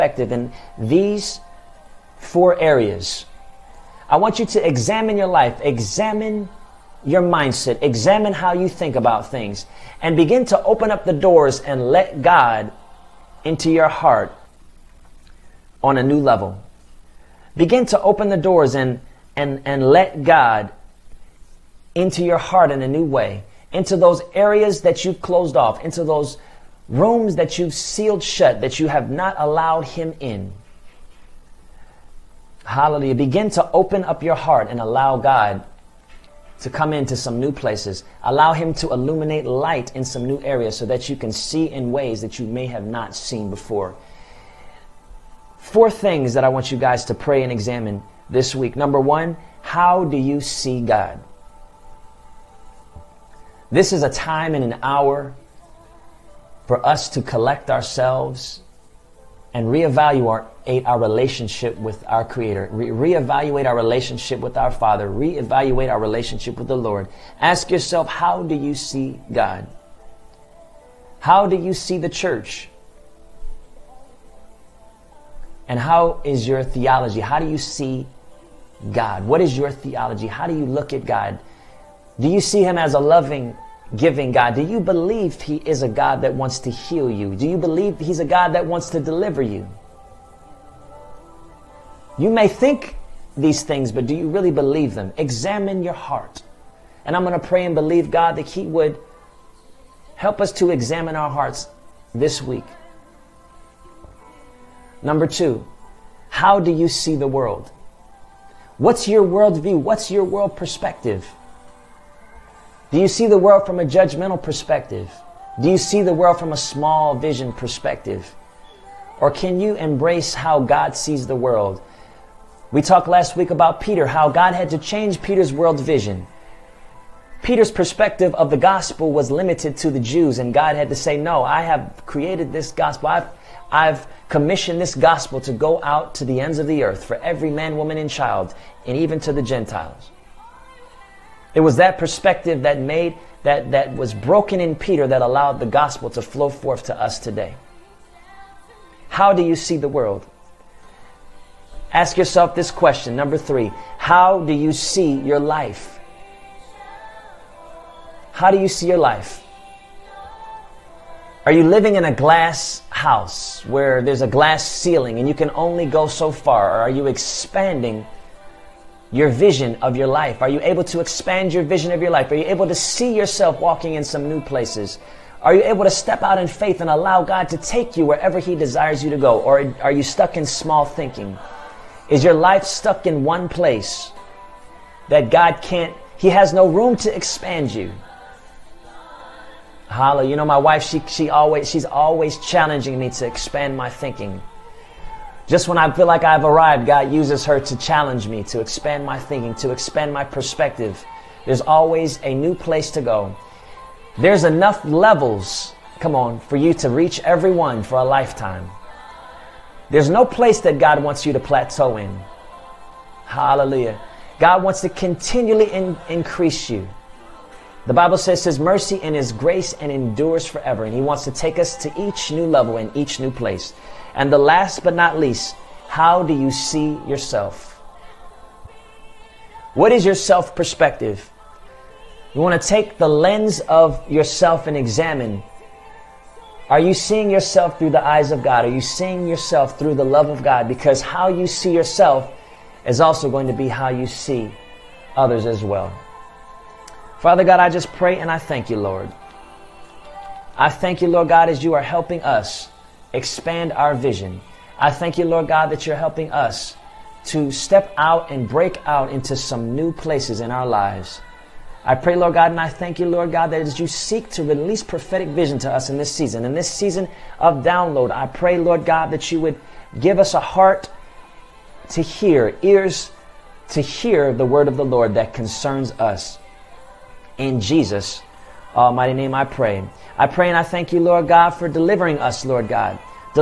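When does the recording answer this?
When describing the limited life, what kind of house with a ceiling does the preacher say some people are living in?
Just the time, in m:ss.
2:42.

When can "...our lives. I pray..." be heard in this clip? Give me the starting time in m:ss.
4:20.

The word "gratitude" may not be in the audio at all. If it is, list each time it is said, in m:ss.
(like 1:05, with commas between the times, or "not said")
not said.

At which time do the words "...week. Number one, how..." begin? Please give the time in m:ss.
0:48.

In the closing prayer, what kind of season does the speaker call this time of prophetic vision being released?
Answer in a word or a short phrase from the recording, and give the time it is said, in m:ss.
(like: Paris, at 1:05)
season of download, at 4:26.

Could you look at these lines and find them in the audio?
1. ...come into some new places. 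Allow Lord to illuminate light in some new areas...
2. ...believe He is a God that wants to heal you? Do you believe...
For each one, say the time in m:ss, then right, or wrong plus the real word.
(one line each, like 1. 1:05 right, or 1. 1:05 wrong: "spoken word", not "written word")
1. 0:36 wrong: "Him", not "Lord"
2. 1:24 right.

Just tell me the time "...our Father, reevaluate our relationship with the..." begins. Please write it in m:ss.
1:04.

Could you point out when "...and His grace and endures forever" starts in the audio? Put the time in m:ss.
3:39.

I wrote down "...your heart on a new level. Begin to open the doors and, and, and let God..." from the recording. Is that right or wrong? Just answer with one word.
right.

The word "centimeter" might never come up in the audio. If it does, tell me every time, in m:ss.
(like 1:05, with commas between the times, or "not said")
not said.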